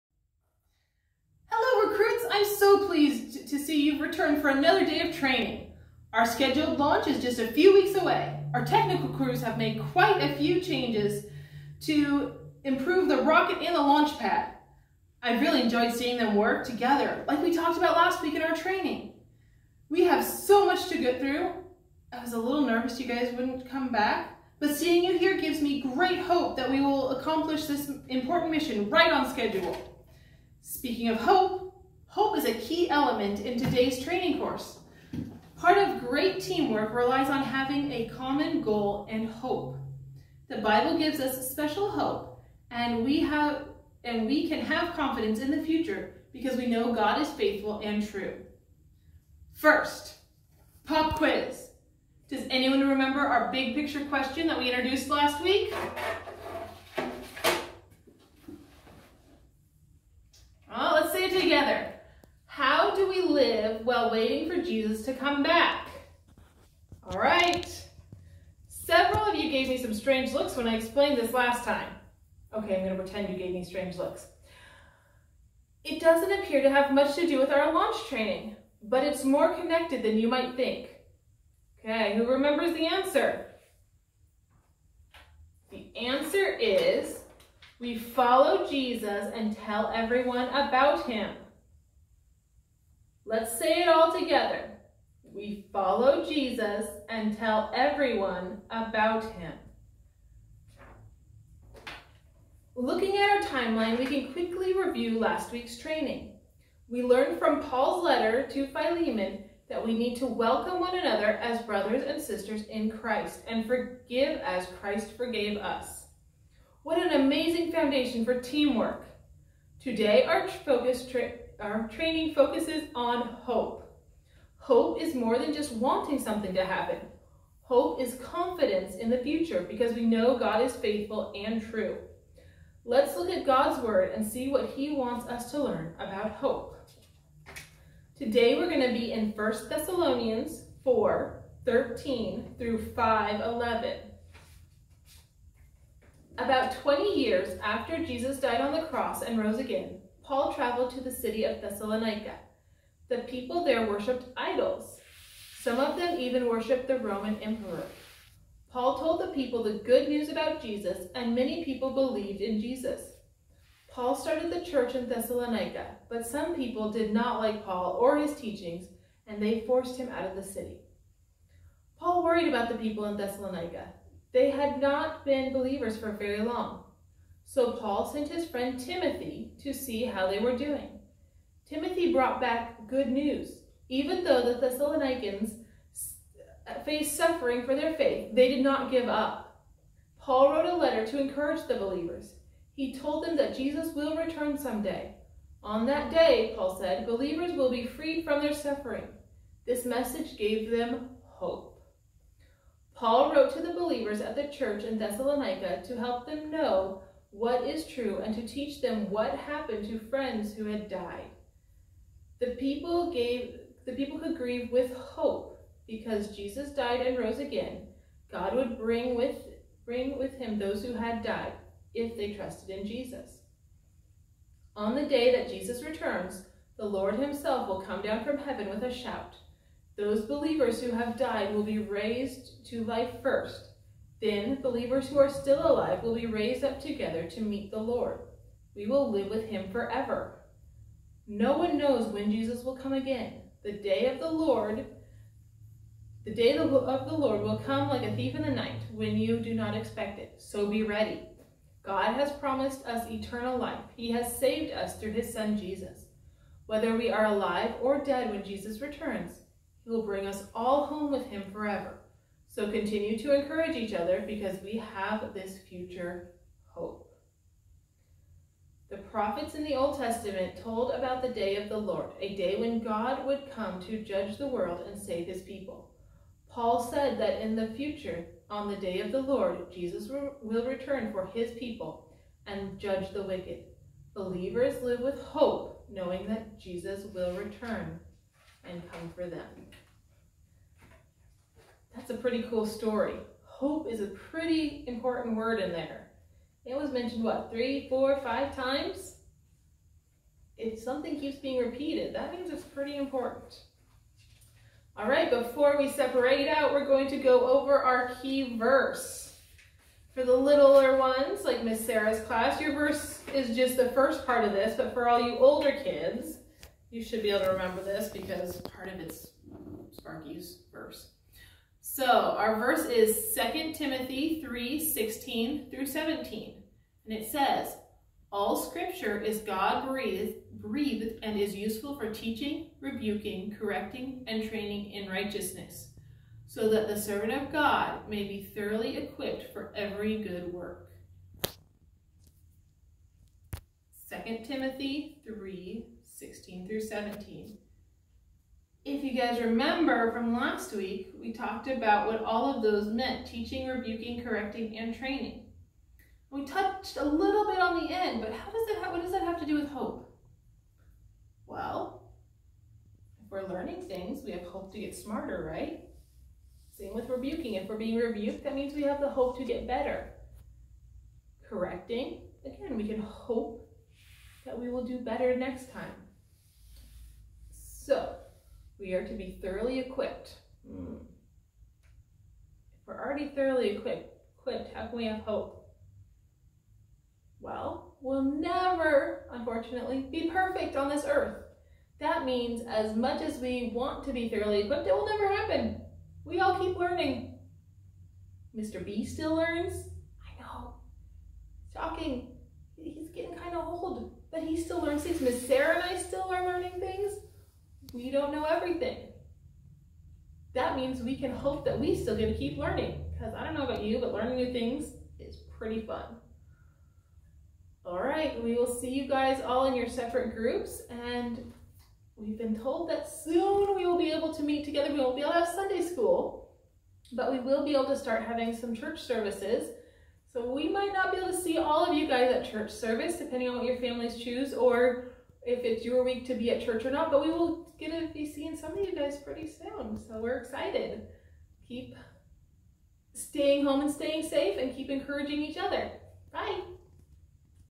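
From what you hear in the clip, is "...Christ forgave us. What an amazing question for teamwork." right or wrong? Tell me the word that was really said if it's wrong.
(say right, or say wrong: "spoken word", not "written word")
wrong: "foundation", not "question".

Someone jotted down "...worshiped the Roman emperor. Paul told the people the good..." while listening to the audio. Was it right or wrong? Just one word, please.
right.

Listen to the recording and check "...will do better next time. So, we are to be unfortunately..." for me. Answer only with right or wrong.
wrong.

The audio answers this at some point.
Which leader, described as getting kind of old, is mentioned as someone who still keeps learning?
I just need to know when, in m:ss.
6:38.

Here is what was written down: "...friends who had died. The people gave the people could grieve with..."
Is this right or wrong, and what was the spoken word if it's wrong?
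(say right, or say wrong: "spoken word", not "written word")
right.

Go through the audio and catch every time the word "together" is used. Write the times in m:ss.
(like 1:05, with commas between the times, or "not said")
0:16, 1:34, 3:56, 7:04.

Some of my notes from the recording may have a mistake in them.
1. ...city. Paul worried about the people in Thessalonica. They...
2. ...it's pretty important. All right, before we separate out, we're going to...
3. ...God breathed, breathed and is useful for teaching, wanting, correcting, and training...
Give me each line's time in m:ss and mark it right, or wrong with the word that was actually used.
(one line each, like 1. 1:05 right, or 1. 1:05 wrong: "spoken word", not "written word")
1. 2:50 right
2. 5:02 right
3. 5:29 wrong: "rebuking", not "wanting".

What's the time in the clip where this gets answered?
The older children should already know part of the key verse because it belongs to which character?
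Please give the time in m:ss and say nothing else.
5:19.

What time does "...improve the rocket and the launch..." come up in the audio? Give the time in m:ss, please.
0:12.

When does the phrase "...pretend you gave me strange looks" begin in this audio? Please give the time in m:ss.
1:13.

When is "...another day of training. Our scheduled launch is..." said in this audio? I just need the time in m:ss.
0:04.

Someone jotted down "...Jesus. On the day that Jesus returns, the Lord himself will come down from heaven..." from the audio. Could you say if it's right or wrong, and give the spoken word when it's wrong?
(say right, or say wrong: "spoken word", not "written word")
right.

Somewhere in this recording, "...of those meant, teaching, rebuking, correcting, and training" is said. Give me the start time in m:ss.
5:52.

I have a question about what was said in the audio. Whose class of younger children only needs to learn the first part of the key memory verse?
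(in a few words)
Miss Sarah's class.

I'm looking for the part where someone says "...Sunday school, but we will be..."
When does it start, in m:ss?
7:05.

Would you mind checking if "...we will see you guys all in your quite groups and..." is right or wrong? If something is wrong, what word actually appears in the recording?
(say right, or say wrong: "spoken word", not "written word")
wrong: "separate", not "quite".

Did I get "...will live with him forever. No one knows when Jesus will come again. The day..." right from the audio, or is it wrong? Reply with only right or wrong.
right.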